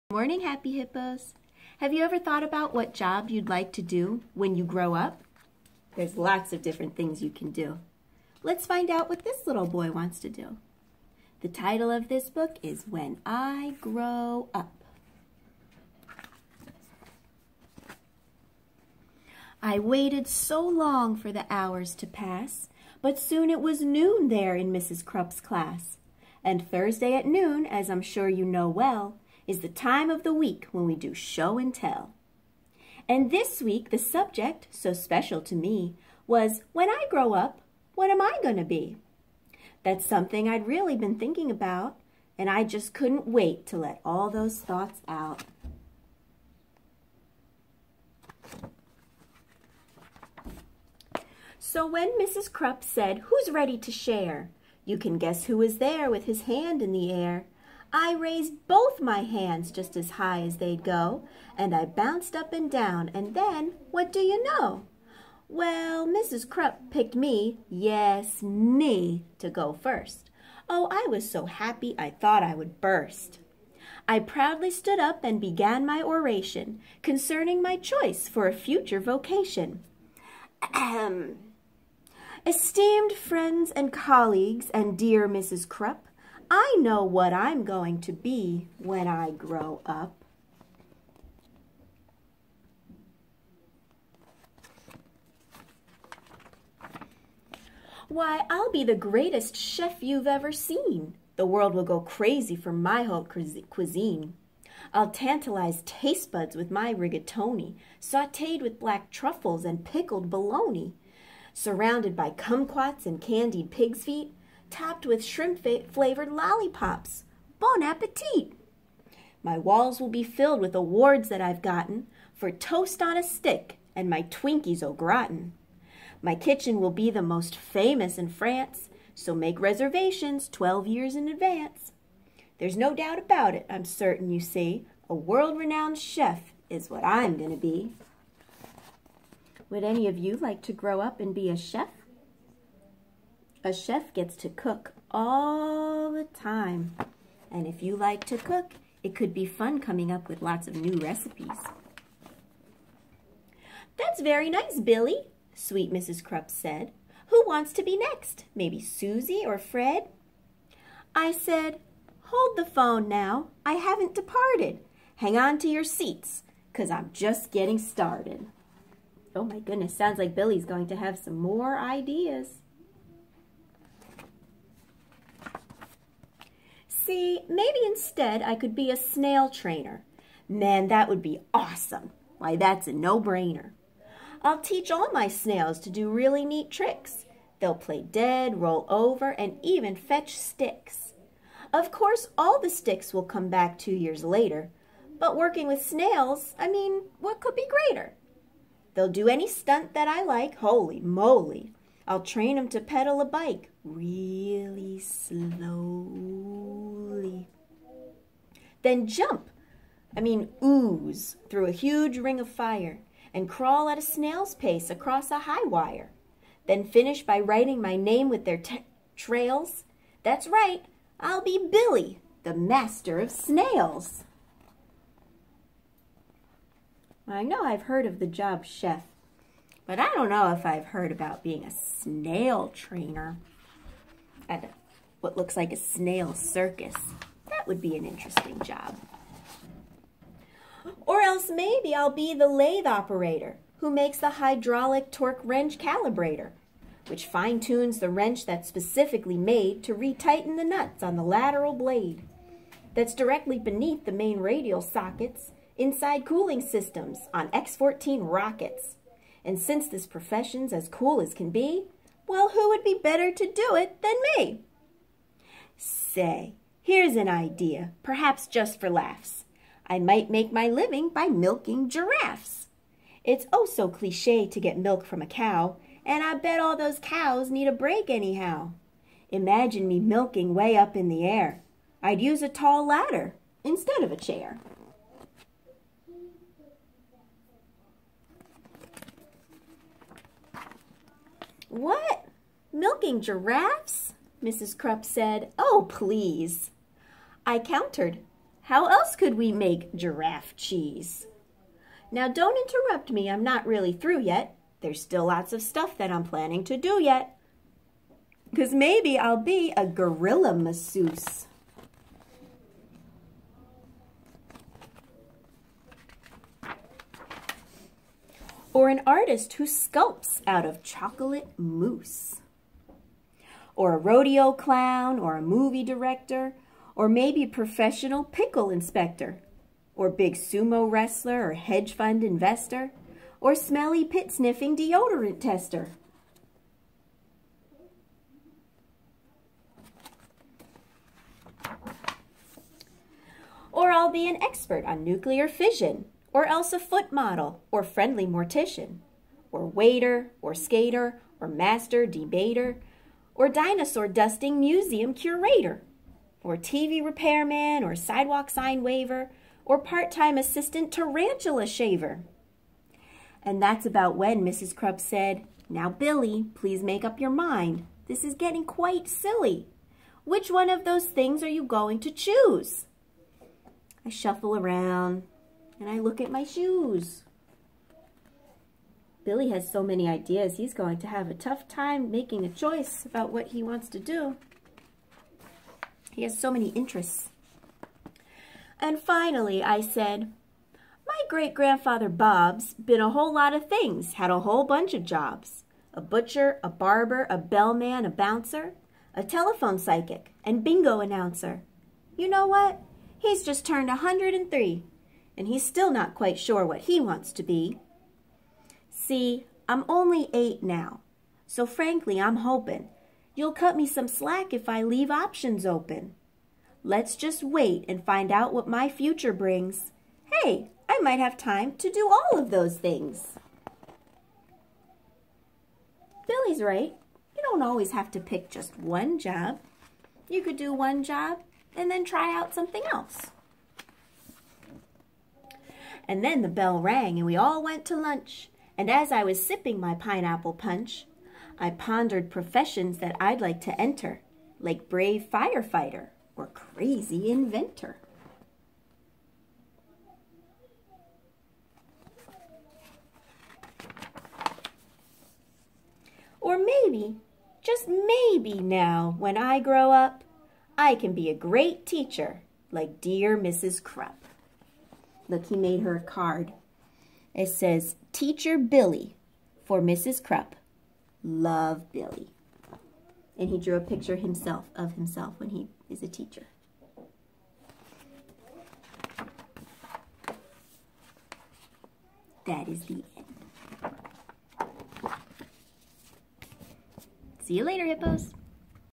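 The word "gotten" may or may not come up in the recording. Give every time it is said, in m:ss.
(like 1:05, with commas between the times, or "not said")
2:01.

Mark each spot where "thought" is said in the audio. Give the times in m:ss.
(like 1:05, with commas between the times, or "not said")
0:02, 0:44, 1:12.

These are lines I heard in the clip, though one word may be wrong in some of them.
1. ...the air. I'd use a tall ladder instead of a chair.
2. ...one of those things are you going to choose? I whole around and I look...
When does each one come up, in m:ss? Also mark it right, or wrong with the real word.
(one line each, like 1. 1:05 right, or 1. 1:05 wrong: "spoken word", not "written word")
1. 4:41 right
2. 6:10 wrong: "shuffle", not "whole".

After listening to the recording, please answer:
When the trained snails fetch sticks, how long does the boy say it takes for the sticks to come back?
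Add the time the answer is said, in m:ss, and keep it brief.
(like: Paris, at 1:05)
2 years, at 3:13.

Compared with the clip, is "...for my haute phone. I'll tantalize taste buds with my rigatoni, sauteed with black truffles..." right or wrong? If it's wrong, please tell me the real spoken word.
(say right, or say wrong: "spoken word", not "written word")
wrong: "cuisine", not "phone".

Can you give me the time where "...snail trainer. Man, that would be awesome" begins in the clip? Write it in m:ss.
2:58.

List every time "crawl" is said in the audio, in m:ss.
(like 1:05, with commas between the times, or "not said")
3:33.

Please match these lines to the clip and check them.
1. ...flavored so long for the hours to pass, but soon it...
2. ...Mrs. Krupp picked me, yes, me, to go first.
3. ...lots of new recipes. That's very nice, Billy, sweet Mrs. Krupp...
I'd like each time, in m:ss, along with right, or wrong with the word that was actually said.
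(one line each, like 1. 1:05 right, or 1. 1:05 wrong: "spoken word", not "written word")
1. 0:19 wrong: "waited", not "flavored"
2. 1:06 right
3. 2:30 right.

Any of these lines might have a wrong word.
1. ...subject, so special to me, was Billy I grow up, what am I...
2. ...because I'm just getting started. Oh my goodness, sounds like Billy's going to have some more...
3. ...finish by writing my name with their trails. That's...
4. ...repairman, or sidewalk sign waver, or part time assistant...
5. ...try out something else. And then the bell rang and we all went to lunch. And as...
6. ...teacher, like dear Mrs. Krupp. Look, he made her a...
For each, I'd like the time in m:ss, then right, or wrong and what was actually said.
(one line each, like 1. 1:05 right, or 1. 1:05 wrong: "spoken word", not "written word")
1. 0:33 wrong: "When", not "Billy"
2. 2:46 right
3. 3:36 right
4. 5:57 right
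5. 7:12 right
6. 7:41 right.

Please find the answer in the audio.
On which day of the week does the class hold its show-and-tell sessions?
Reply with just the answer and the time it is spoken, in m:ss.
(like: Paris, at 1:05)
Thursday, at 0:26.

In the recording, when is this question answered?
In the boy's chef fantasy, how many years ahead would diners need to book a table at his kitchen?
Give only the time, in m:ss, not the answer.
2:10.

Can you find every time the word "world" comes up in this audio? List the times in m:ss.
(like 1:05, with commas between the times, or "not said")
1:41, 2:15.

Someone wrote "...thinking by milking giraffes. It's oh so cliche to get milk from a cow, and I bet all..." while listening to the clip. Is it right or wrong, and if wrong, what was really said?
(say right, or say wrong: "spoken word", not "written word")
wrong: "living", not "thinking".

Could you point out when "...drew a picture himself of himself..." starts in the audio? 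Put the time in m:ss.
7:53.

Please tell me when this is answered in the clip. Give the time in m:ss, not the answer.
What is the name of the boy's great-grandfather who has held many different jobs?
6:32.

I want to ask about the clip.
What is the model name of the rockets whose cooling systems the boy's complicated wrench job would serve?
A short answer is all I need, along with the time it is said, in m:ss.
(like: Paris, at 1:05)
X-14, at 4:17.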